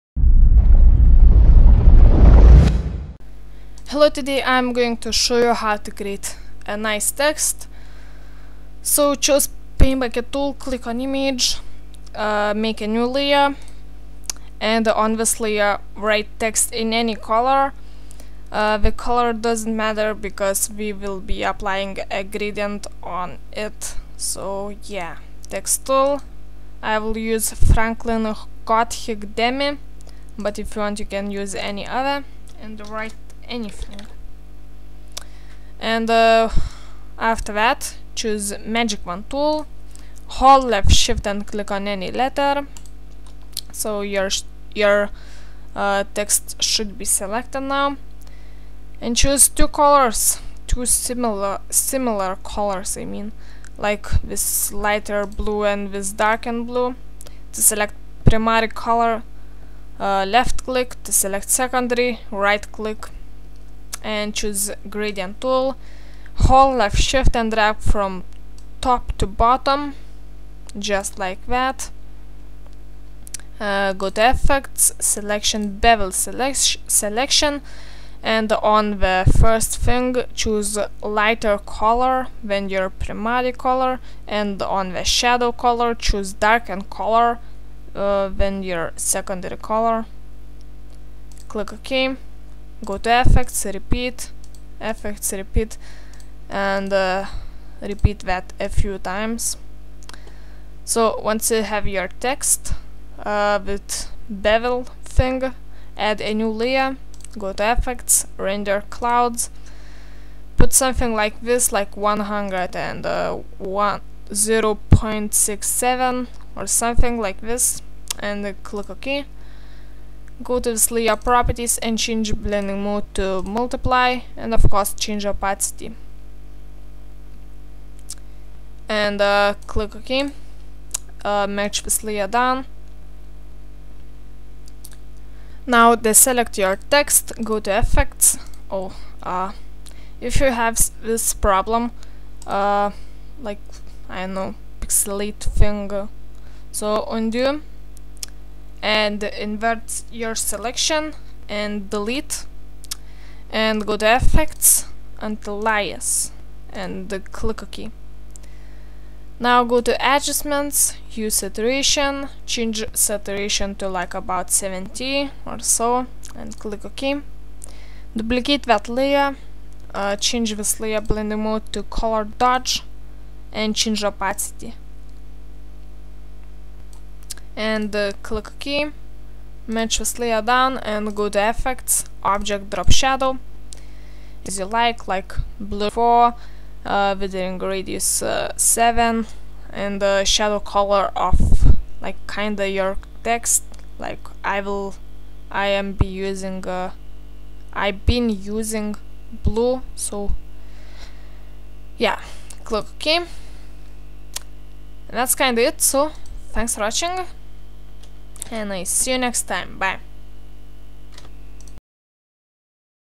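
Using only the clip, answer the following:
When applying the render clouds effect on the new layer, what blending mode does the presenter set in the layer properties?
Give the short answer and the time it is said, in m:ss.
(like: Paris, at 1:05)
Multiply, at 2:03.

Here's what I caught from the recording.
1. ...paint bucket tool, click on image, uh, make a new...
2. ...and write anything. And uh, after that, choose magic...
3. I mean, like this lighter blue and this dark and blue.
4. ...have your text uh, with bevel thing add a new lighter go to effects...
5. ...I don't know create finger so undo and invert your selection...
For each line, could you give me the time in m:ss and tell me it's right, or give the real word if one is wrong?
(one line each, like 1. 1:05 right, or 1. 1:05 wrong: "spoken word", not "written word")
1. 0:09 right
2. 0:32 right
3. 0:52 right
4. 1:41 wrong: "layer", not "lighter"
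5. 2:24 wrong: "pixelate", not "create".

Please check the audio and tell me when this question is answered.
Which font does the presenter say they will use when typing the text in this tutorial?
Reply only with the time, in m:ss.
0:27.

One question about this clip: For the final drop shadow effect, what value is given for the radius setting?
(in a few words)
7.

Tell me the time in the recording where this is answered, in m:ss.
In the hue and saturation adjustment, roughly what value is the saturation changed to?
2:44.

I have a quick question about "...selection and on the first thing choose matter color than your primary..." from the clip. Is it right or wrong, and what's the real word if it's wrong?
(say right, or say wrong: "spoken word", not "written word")
wrong: "lighter", not "matter".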